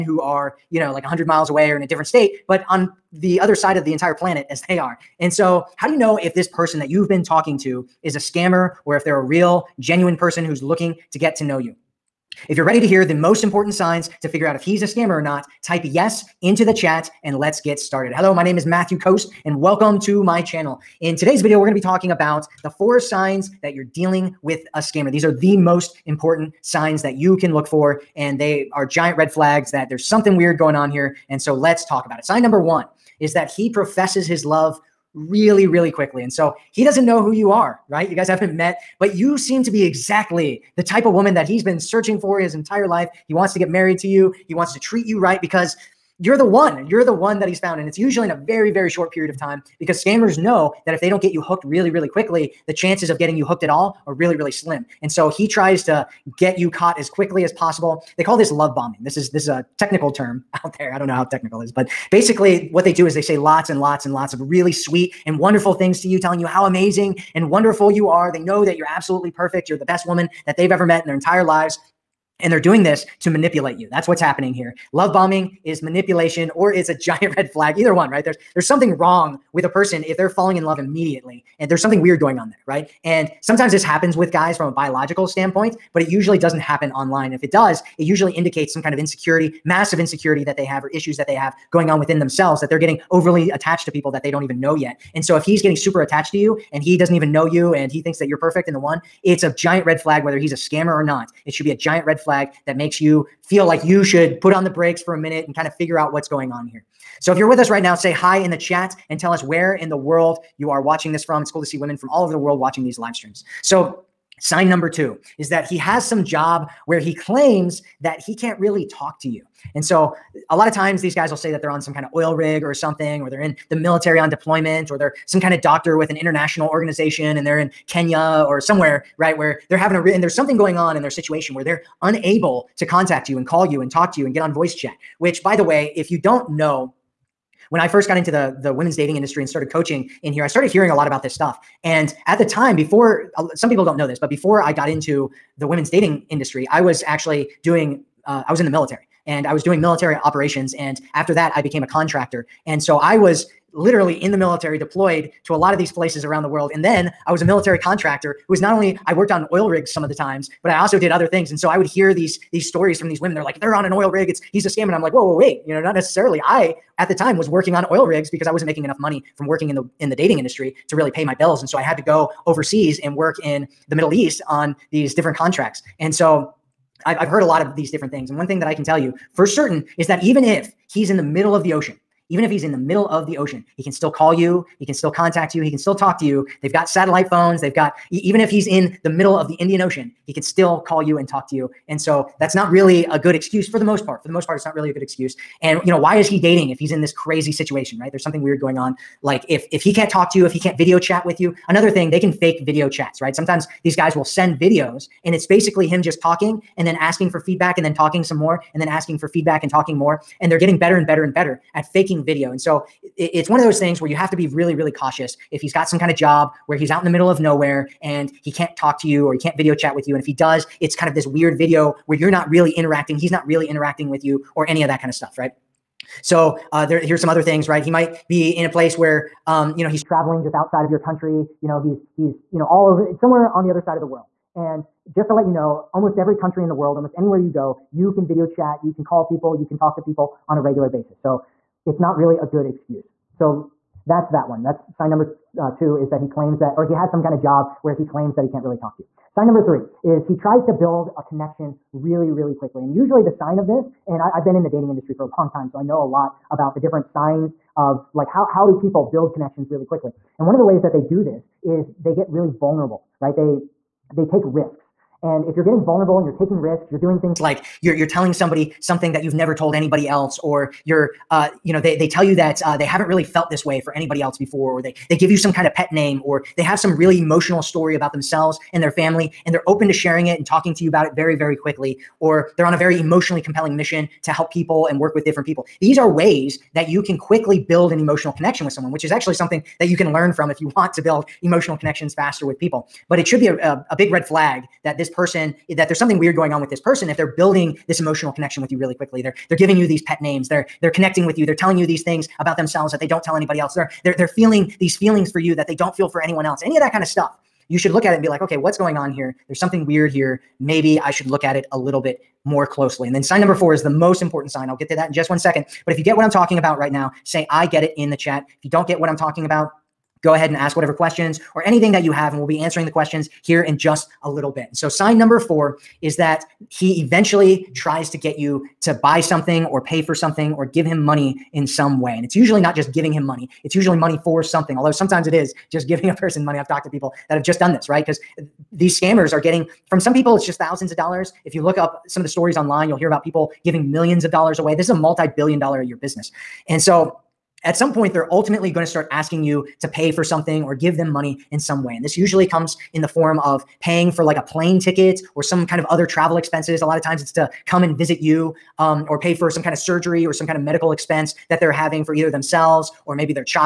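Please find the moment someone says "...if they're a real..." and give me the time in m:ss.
0:08.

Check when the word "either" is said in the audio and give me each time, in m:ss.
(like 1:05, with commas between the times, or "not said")
1:17, 6:02.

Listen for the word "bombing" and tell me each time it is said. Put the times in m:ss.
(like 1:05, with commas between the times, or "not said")
0:58, 1:15.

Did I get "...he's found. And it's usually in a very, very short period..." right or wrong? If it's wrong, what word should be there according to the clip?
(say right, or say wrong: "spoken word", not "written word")
right.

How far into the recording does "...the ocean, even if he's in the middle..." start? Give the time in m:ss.
3:01.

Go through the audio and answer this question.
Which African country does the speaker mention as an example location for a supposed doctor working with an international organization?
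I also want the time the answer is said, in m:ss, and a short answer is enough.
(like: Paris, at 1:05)
Kenya, at 2:07.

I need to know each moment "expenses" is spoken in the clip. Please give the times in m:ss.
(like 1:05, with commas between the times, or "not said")
5:56, 6:00.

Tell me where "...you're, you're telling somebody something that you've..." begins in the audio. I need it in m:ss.
4:27.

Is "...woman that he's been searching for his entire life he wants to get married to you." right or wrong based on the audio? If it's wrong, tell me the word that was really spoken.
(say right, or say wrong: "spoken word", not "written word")
right.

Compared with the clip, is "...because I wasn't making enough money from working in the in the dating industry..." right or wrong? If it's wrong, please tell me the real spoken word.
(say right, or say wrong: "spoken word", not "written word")
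right.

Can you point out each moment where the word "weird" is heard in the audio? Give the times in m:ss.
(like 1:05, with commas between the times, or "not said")
0:30, 1:22, 3:18, 3:41, 4:56, 5:09.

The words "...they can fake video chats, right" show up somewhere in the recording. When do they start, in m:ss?
3:22.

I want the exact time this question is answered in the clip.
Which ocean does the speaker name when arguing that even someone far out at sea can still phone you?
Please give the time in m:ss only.
3:09.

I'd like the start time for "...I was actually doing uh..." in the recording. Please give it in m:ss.
2:26.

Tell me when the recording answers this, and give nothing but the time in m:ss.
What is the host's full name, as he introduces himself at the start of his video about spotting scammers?
0:18.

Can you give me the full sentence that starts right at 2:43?
They're like, if they're on an oil rig, it's he's a scam.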